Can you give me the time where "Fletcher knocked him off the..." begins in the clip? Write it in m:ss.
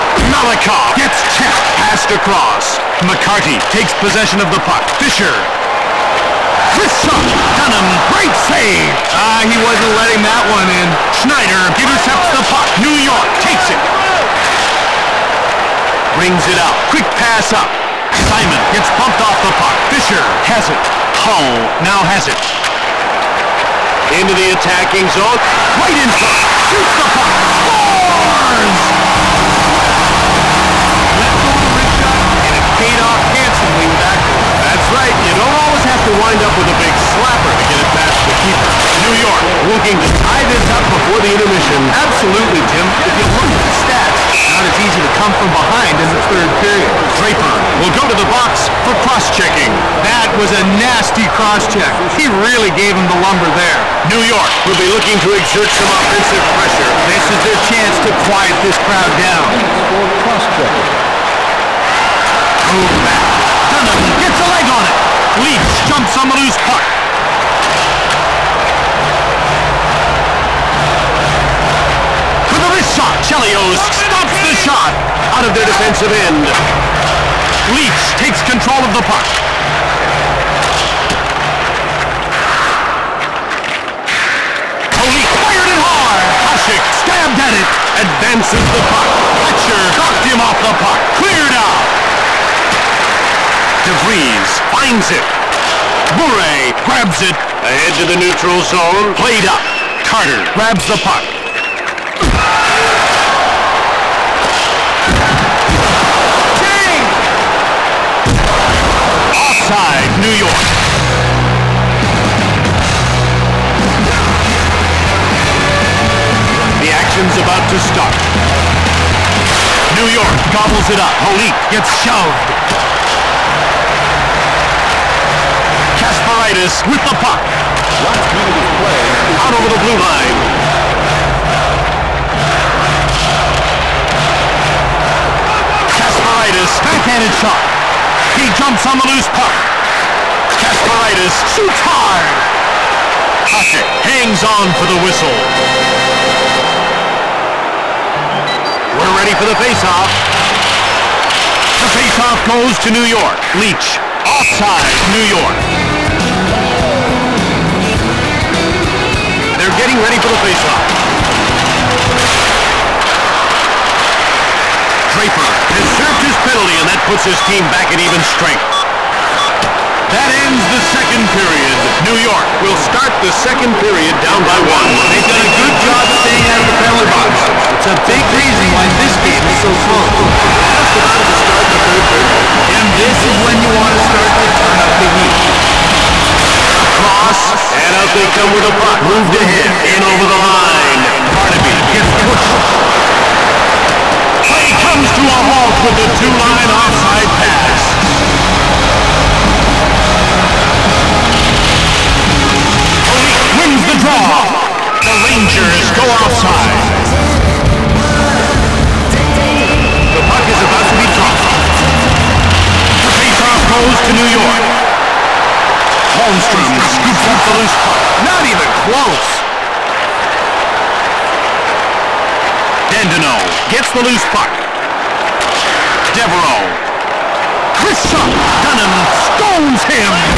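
1:29.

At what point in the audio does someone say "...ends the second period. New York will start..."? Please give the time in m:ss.
2:50.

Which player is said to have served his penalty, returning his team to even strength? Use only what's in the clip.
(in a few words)
Draper.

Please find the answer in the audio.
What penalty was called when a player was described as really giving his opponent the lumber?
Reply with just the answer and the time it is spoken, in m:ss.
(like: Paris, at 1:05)
Cross-checking, at 0:49.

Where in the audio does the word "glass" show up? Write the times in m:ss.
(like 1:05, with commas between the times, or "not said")
not said.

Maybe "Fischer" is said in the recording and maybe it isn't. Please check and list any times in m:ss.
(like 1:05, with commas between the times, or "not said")
0:04, 0:19.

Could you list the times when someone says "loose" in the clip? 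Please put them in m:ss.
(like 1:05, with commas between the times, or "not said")
1:06, 2:19, 3:37, 3:44.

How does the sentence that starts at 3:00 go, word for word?
We're just about to start the third period.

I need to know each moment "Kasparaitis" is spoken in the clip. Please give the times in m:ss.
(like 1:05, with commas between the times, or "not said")
2:05, 2:15.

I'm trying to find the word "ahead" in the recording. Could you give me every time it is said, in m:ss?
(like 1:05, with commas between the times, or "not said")
1:37, 3:09.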